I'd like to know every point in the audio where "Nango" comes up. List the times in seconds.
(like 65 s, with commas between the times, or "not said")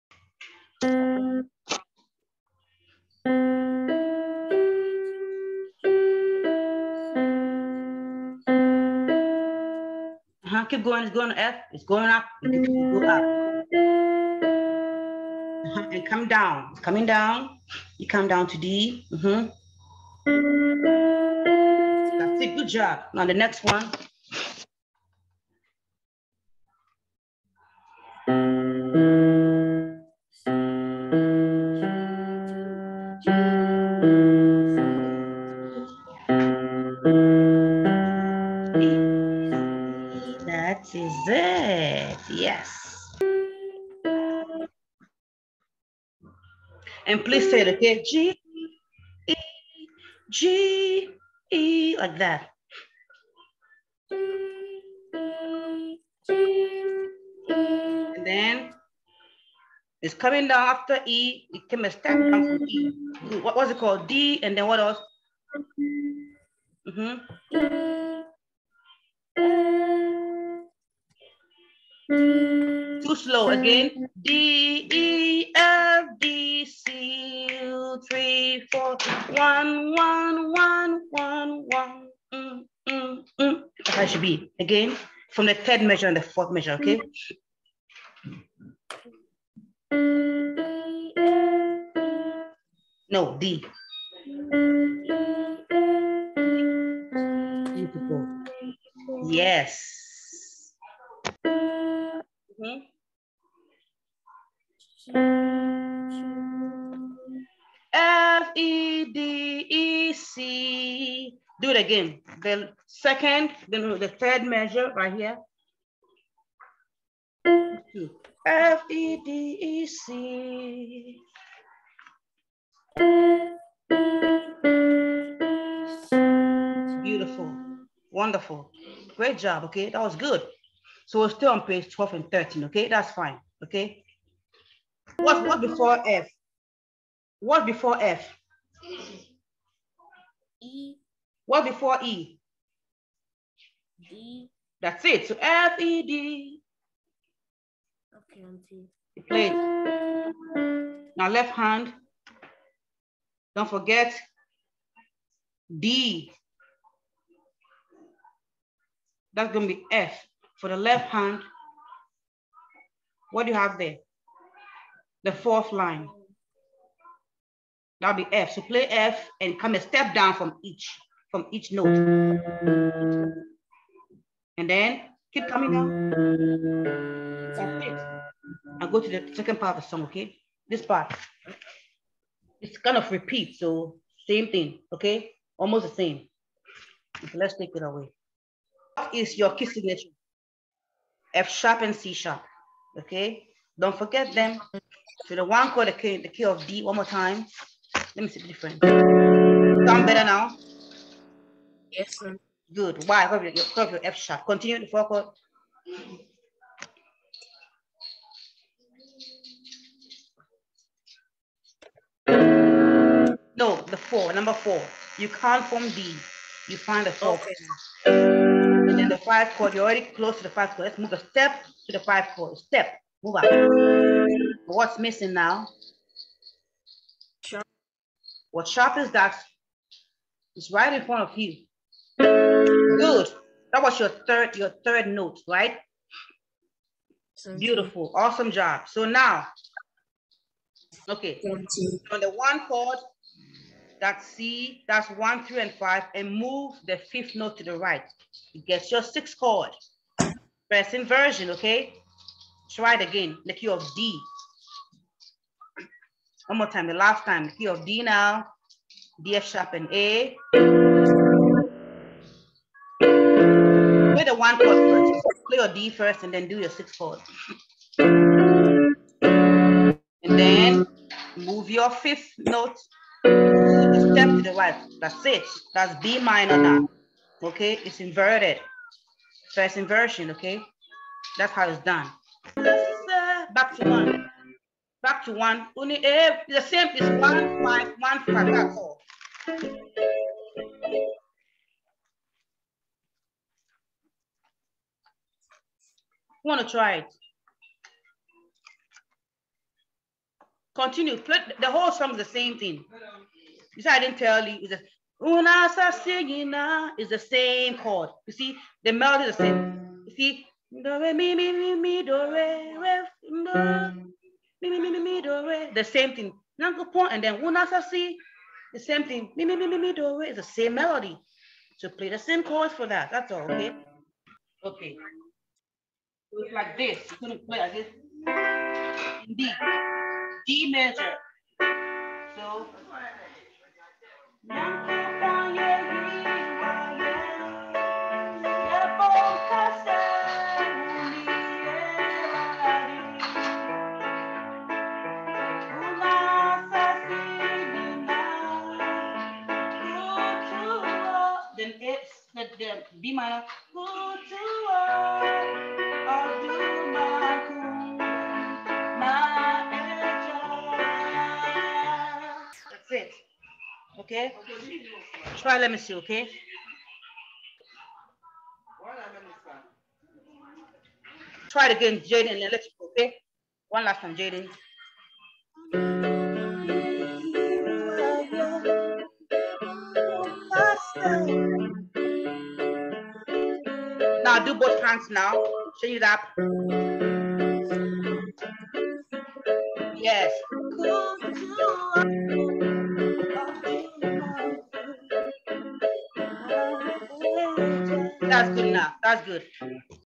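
316 s.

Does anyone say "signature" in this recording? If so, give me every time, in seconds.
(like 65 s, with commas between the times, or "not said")
189 s.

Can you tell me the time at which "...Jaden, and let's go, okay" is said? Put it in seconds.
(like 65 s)
371 s.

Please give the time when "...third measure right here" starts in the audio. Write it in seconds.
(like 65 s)
114 s.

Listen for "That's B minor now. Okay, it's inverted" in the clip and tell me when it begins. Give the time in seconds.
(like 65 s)
275 s.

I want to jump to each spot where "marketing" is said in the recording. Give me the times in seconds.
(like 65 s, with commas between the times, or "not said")
not said.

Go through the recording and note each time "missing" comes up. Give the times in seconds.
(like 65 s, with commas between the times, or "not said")
224 s.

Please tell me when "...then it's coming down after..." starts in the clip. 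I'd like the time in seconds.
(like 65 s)
58 s.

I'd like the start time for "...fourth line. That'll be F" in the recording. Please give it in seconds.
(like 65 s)
165 s.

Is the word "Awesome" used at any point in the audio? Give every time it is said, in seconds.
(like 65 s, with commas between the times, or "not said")
238 s.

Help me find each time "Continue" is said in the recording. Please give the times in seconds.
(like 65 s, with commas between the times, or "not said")
204 s, 300 s.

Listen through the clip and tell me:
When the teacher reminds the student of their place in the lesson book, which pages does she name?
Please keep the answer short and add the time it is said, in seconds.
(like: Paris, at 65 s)
12 and 13, at 131 s.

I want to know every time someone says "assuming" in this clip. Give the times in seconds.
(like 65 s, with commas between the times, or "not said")
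not said.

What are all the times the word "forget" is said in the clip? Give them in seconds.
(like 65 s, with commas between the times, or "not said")
153 s, 193 s.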